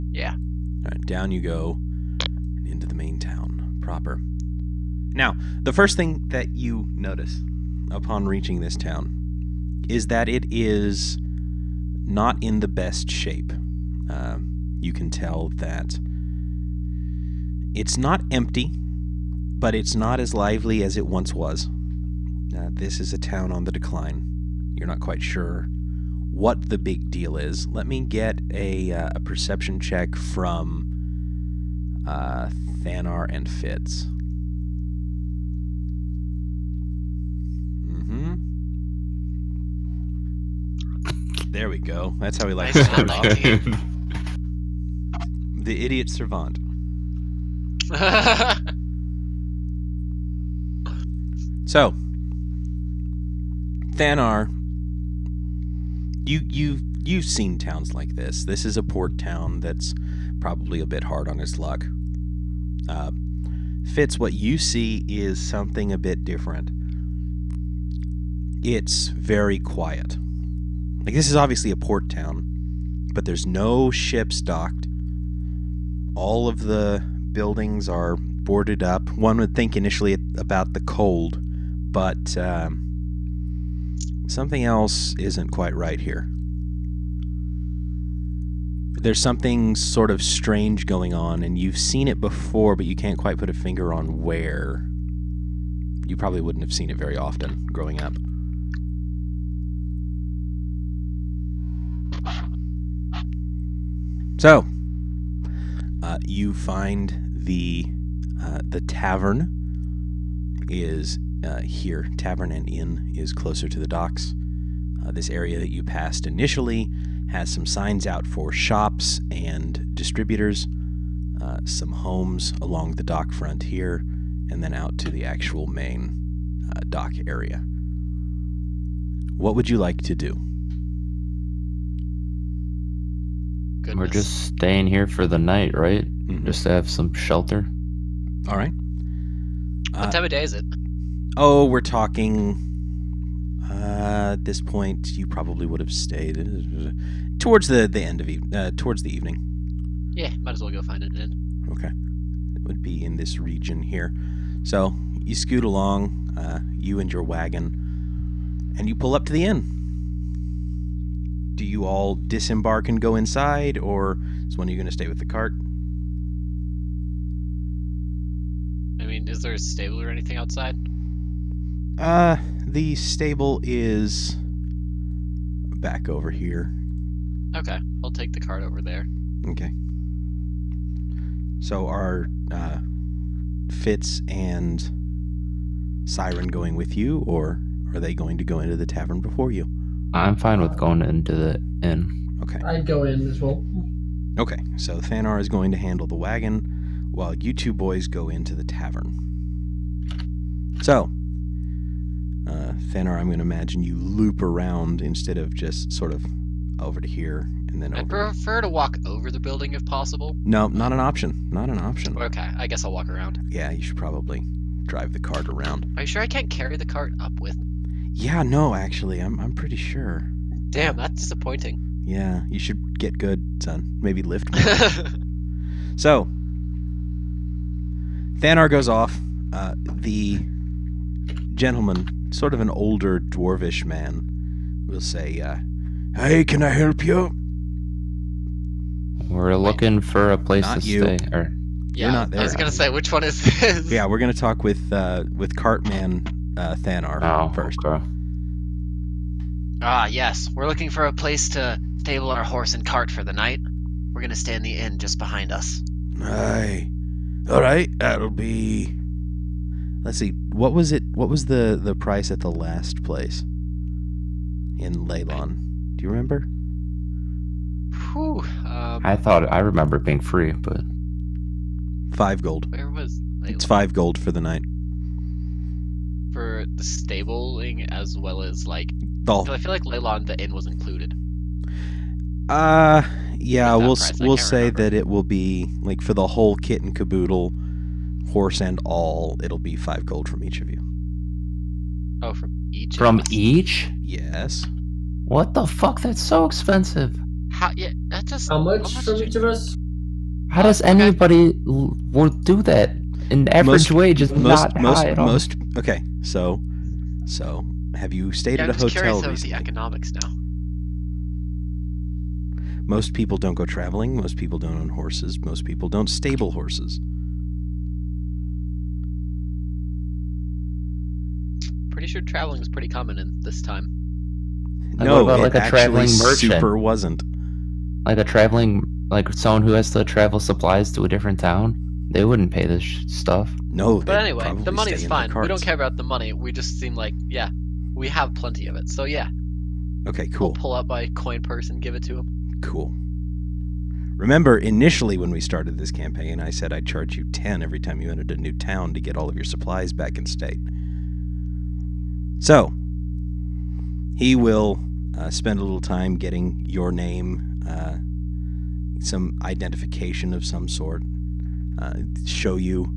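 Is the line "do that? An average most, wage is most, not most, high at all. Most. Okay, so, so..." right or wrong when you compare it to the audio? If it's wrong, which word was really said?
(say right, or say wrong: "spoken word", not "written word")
right.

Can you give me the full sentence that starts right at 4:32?
Where was it's five gold for the night for the stabling as well as like.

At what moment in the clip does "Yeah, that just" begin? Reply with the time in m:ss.
4:57.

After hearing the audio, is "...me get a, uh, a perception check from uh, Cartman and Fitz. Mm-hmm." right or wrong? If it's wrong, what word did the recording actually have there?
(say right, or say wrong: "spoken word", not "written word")
wrong: "Thanar", not "Cartman".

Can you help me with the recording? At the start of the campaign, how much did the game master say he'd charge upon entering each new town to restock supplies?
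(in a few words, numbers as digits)
10.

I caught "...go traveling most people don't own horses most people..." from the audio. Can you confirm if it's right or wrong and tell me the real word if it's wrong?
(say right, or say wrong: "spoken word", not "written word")
right.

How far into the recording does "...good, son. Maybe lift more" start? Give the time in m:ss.
3:43.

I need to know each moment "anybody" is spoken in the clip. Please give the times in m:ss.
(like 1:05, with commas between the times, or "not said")
5:00.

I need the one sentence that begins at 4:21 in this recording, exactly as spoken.
What was the the price at the last place in Leilon?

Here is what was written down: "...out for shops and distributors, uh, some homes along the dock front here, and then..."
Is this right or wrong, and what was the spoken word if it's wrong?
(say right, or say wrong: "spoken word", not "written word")
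right.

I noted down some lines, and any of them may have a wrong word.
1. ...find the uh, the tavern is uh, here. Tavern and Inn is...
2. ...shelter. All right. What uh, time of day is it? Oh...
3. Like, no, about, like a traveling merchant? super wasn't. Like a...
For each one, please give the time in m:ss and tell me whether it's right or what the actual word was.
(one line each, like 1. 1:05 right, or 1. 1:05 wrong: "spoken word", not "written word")
1. 1:46 right
2. 2:17 right
3. 5:24 right.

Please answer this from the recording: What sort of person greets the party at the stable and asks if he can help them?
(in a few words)
An older dwarvish man.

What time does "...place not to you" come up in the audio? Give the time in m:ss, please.
4:00.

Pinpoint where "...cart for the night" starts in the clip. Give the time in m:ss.
4:12.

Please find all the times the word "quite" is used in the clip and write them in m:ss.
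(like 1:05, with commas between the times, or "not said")
0:24, 1:25, 1:33.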